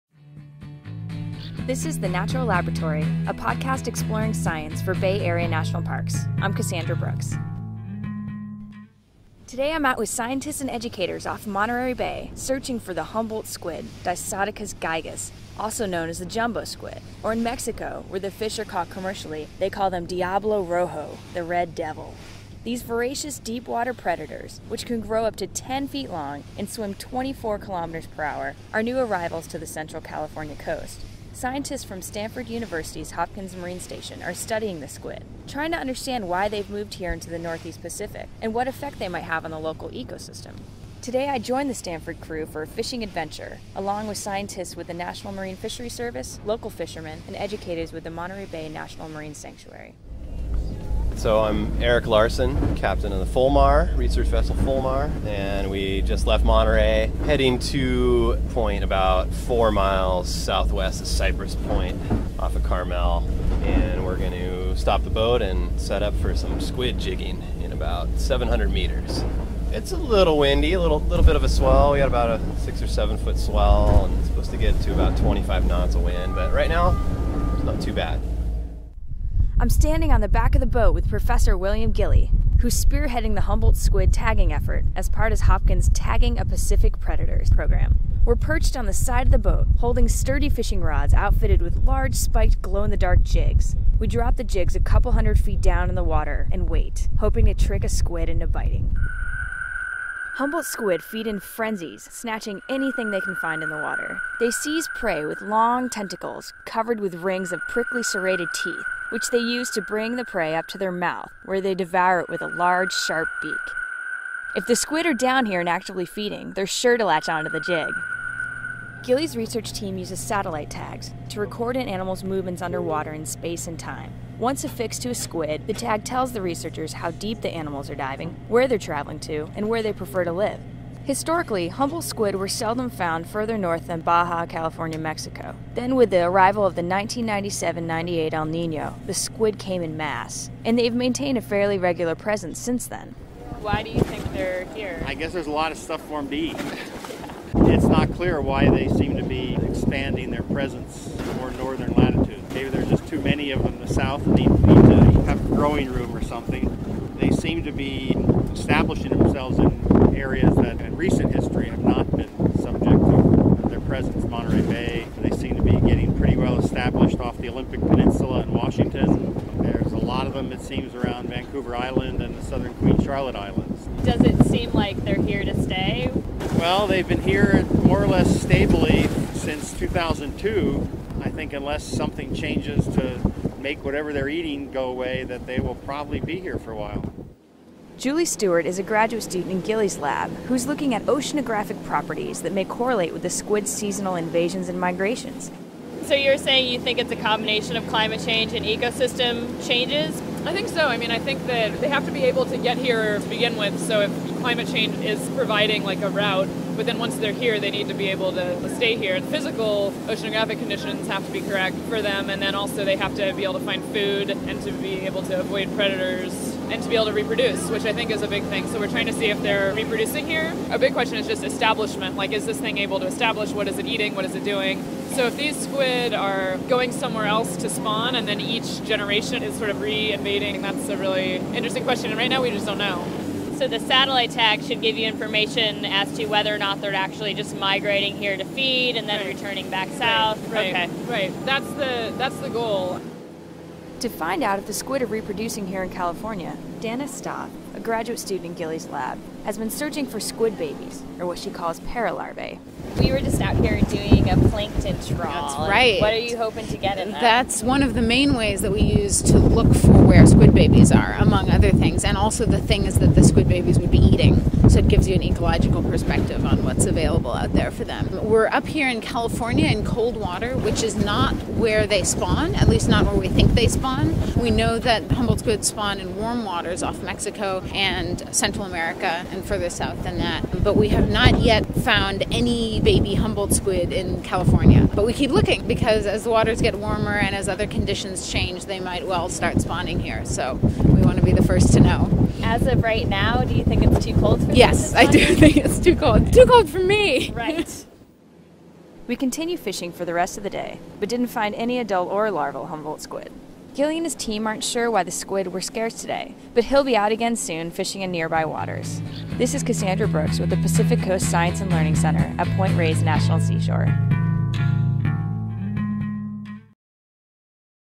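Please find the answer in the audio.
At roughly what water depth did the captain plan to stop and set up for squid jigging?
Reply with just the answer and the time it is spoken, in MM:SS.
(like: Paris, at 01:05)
700 meters, at 01:08.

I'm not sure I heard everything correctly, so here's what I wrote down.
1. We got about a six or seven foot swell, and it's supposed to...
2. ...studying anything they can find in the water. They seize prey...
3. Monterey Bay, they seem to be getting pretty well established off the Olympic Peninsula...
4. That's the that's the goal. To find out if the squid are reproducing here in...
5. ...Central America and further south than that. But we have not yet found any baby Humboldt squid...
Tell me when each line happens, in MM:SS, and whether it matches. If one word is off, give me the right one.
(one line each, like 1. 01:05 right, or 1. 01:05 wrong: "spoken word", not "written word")
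1. 01:11 right
2. 01:42 wrong: "snatching", not "studying"
3. 02:44 right
4. 04:01 right
5. 04:38 right.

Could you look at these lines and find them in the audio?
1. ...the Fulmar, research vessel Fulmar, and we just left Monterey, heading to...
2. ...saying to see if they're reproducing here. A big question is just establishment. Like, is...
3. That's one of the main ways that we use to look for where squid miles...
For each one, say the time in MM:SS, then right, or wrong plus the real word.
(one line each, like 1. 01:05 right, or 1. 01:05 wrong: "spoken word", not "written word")
1. 00:53 right
2. 03:38 wrong: "trying", not "saying"
3. 04:17 wrong: "babies", not "miles".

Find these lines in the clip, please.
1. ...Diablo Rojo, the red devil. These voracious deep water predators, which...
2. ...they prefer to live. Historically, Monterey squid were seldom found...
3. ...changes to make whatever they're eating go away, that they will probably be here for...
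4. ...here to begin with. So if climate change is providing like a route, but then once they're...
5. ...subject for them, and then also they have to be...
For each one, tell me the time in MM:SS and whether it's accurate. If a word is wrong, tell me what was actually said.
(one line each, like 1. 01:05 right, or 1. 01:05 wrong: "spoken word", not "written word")
1. 00:20 right
2. 02:09 wrong: "Humboldt", not "Monterey"
3. 03:02 right
4. 03:22 right
5. 03:31 wrong: "correct", not "subject".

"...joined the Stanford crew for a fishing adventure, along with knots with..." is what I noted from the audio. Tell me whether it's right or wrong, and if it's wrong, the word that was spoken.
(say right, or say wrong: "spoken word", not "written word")
wrong: "scientists", not "knots".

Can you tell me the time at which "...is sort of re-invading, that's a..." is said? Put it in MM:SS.
03:49.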